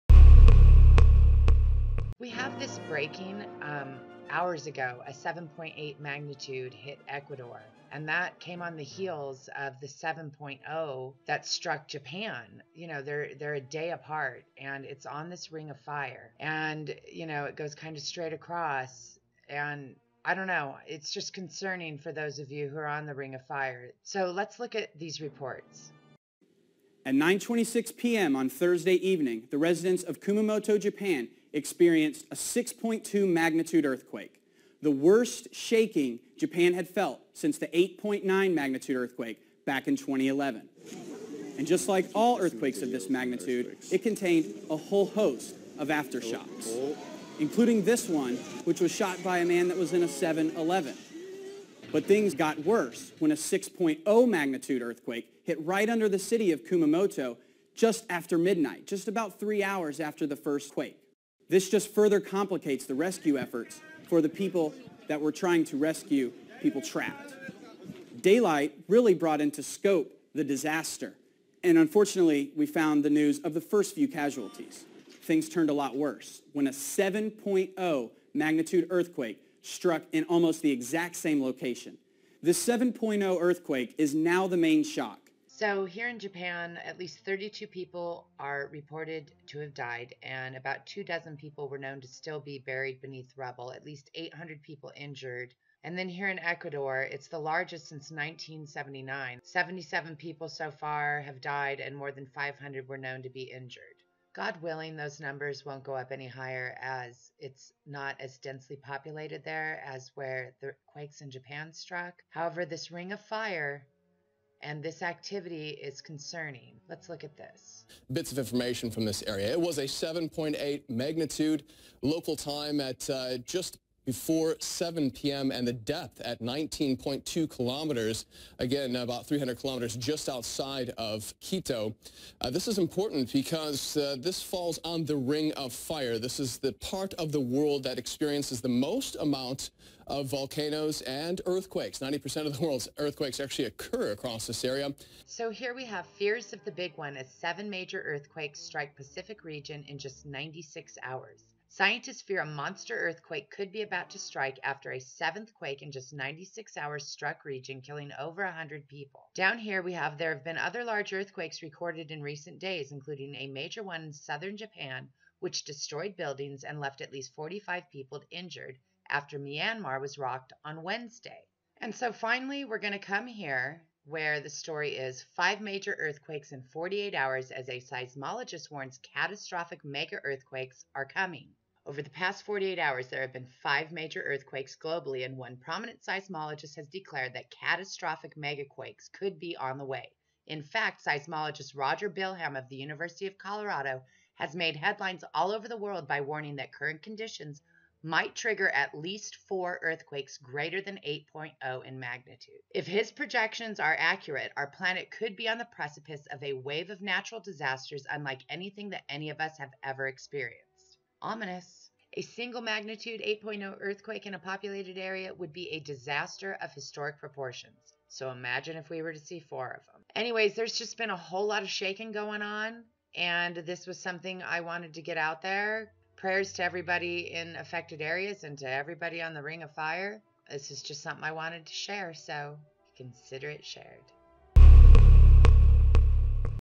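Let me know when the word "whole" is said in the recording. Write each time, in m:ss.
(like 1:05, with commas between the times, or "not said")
0:44, 3:41.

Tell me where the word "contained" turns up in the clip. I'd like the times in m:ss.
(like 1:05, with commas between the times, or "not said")
0:44.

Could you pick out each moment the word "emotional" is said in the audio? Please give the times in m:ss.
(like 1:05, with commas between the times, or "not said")
not said.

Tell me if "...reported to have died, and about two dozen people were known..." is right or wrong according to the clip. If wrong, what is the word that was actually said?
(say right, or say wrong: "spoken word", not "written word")
right.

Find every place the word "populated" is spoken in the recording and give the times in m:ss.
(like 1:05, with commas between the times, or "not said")
1:48, 3:34.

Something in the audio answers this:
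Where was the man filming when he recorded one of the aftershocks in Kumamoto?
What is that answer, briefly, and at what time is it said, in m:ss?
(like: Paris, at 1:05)
7-Eleven, at 0:50.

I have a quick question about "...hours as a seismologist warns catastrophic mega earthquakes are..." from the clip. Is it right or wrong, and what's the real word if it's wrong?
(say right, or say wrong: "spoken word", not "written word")
right.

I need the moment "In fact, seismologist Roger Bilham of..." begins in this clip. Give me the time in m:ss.
3:10.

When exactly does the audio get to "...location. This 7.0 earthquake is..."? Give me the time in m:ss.
1:21.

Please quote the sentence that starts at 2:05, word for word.
and the depth at 19.2 kilometers, again, about 300 kilometers just outside of Quito.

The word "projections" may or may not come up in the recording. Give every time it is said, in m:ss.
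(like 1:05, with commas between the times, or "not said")
3:23.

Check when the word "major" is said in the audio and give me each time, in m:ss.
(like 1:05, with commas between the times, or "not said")
2:27, 2:43, 2:55, 3:03.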